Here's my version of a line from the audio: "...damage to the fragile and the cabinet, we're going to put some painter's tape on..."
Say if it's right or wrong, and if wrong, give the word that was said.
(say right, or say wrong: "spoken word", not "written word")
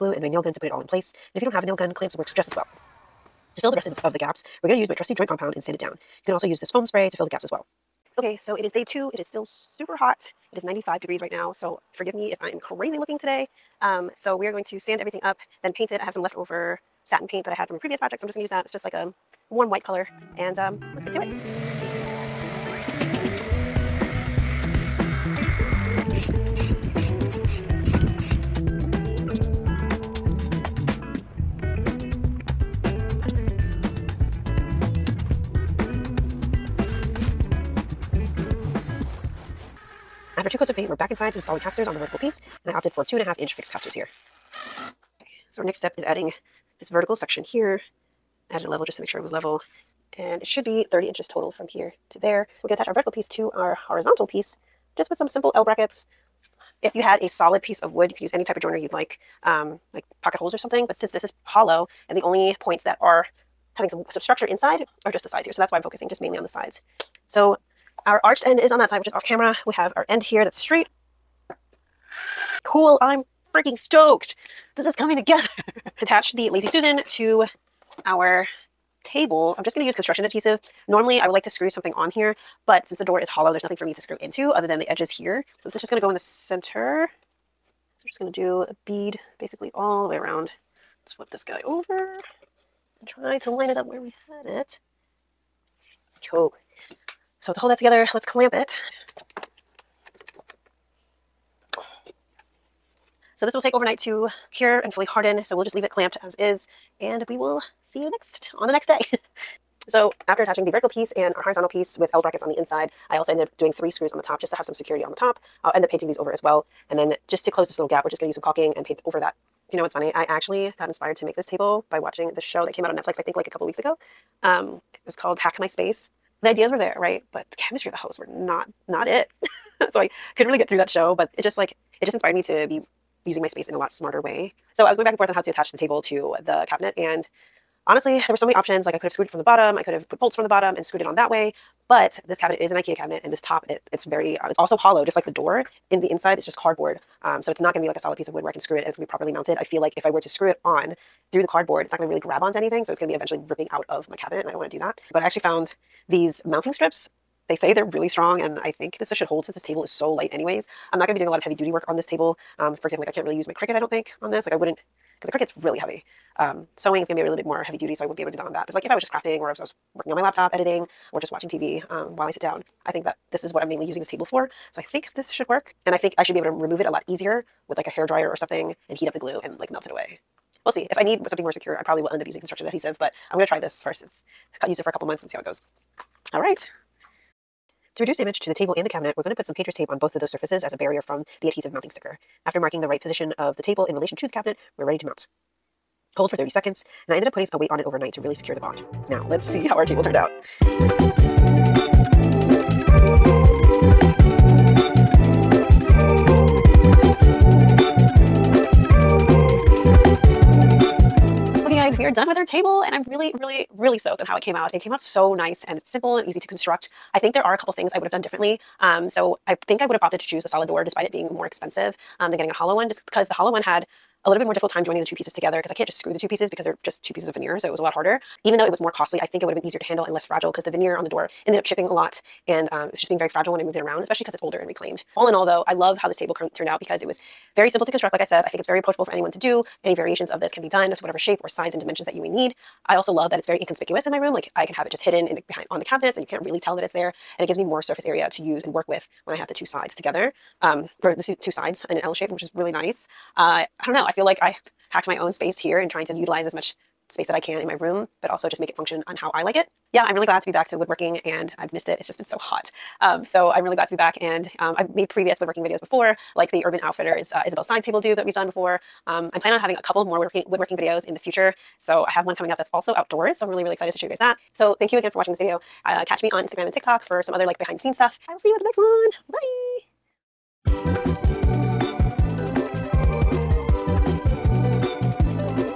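wrong: "table", not "fragile".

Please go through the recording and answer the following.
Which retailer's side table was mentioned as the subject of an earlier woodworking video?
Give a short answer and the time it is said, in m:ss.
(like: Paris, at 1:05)
Urban Outfitters, at 4:26.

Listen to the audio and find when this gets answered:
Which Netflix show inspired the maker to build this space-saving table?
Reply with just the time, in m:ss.
2:05.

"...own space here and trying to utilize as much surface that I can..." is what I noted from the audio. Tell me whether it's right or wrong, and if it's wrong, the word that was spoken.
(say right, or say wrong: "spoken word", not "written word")
wrong: "space", not "surface".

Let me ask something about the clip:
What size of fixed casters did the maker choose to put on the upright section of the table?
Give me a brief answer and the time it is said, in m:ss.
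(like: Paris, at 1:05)
2.5 inch, at 0:43.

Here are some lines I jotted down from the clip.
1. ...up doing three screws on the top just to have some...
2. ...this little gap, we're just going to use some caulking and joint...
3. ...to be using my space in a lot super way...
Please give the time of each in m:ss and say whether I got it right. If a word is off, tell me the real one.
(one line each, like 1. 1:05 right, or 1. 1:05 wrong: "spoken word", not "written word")
1. 1:53 right
2. 1:57 wrong: "paint", not "joint"
3. 2:12 wrong: "smarter", not "super".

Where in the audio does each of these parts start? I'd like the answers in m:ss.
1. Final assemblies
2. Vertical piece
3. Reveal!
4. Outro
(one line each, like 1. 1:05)
1. 1:06
2. 0:39
3. 3:20
4. 3:31.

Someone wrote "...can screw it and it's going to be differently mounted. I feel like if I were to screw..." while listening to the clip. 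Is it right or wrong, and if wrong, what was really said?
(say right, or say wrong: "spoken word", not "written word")
wrong: "properly", not "differently".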